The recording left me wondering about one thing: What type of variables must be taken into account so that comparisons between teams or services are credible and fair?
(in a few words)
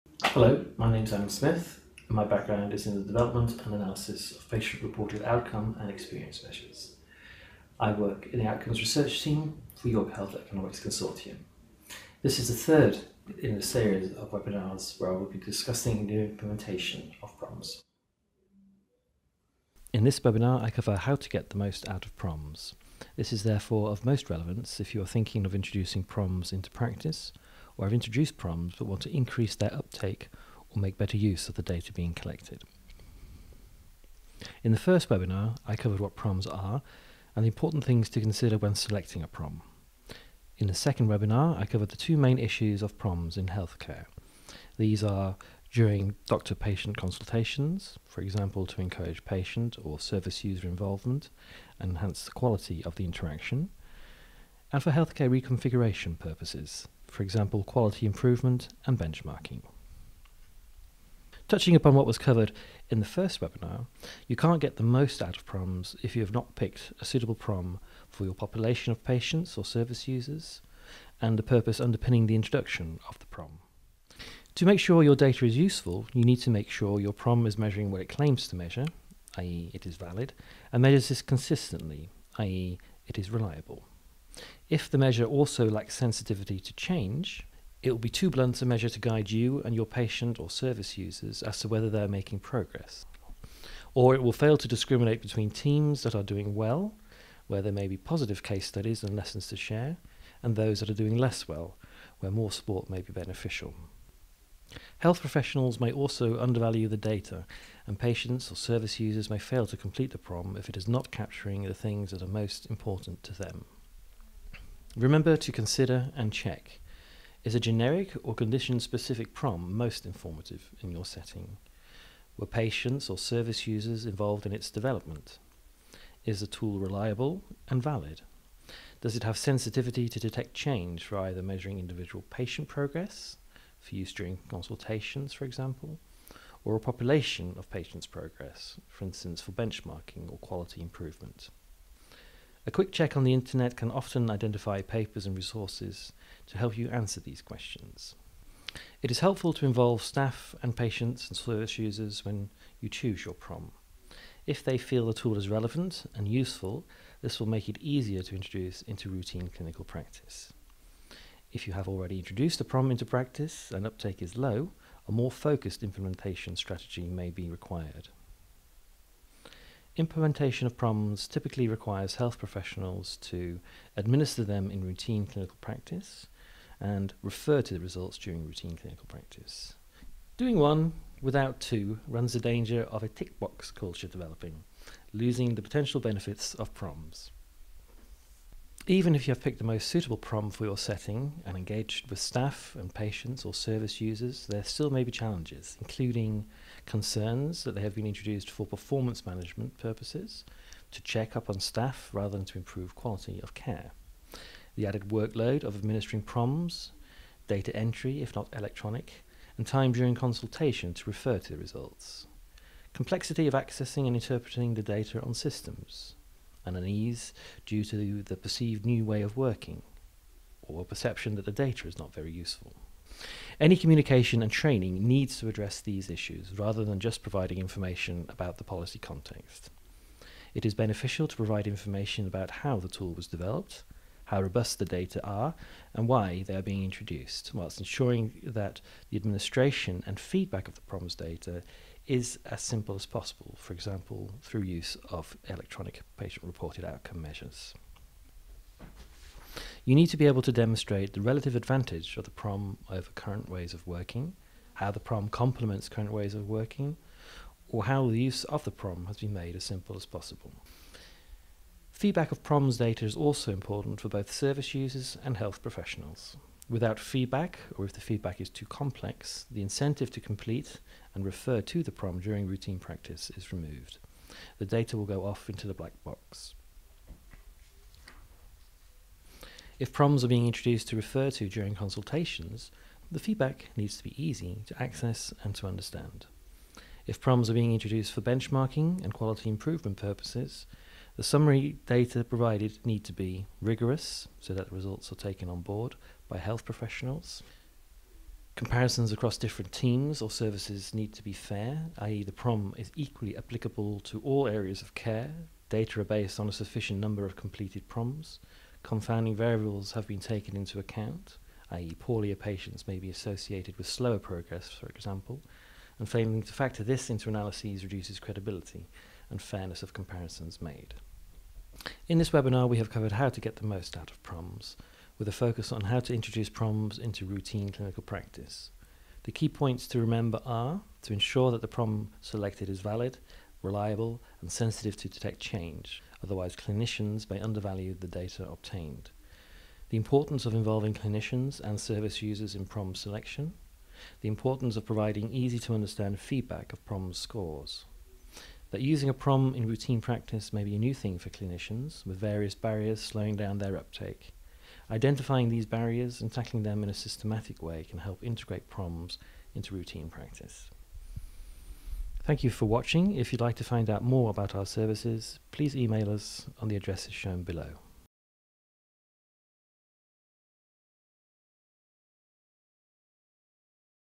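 confounding variables.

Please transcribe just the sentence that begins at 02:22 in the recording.
A quick check on the internet can often identify papers and resources to help you answer these questions.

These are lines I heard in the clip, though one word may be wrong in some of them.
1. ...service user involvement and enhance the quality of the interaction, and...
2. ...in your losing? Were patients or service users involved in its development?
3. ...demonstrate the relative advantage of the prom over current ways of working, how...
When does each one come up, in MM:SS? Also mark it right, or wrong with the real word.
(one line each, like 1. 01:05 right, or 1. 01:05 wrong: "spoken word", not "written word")
1. 00:49 right
2. 02:00 wrong: "setting", not "losing"
3. 04:10 right.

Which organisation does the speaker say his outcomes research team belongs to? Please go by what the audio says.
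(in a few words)
York Health Economics Consortium.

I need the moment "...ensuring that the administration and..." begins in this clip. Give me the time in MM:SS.
03:57.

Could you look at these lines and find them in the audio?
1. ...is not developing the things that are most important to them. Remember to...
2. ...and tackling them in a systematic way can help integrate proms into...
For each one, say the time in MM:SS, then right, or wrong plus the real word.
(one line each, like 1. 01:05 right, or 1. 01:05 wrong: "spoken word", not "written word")
1. 01:50 wrong: "capturing", not "developing"
2. 05:56 right.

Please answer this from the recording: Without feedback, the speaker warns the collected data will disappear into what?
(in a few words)
the black box.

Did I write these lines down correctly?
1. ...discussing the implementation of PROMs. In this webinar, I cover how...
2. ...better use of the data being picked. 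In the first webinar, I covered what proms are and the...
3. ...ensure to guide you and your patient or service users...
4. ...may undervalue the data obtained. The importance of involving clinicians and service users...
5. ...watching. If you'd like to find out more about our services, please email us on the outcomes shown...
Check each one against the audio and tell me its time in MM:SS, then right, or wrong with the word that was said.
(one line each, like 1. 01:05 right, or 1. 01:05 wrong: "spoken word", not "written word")
1. 00:15 right
2. 00:30 wrong: "collected", not "picked"
3. 01:28 wrong: "measure", not "ensure"
4. 05:37 right
5. 06:02 wrong: "addresses", not "outcomes".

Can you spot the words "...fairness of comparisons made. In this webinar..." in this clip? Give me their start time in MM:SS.
05:19.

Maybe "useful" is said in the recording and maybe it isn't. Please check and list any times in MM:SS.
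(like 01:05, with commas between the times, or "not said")
01:15, 02:36, 03:42.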